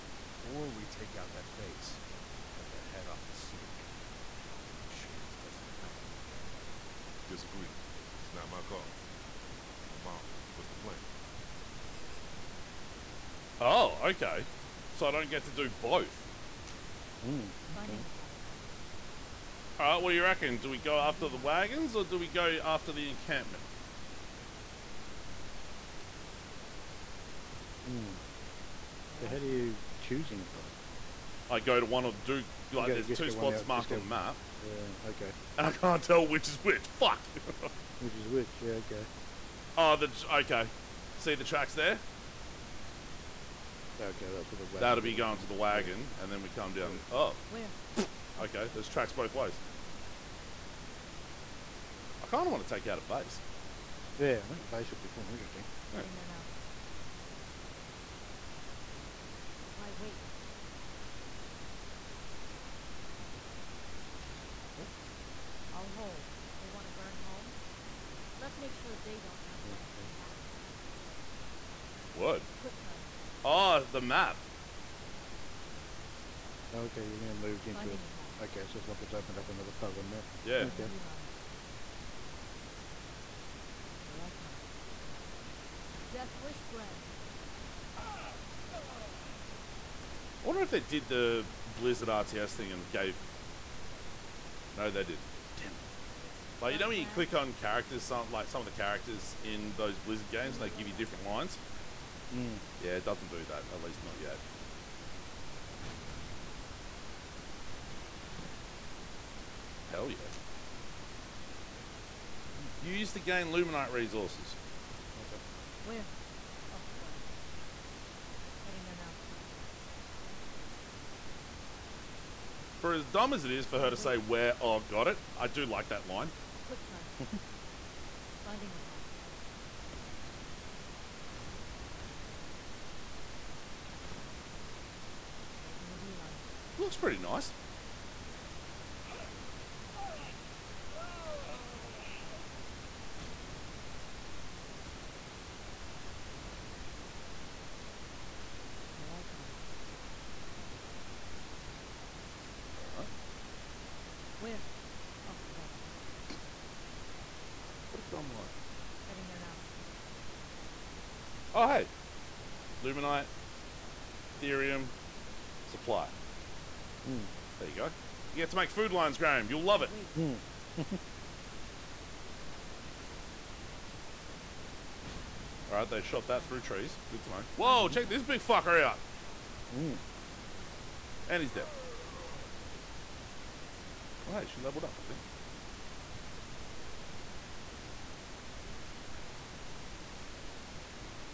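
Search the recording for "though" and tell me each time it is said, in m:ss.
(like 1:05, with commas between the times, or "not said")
0:30.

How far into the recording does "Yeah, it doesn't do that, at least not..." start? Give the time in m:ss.
1:42.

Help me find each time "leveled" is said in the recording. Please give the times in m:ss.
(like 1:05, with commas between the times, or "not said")
3:04.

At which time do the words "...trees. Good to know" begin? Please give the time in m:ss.
2:56.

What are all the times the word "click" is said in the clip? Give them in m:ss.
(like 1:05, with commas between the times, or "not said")
1:37.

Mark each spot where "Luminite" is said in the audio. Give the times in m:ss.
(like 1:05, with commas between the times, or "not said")
1:53, 2:42.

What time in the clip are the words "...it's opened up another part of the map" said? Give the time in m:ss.
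1:19.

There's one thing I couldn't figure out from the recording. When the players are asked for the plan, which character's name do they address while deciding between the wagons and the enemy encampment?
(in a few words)
Amara.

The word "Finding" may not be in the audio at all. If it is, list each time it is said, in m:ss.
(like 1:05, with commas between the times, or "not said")
0:17, 1:17, 2:08.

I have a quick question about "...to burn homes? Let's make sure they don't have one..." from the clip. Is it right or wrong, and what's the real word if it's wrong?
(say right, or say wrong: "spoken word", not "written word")
right.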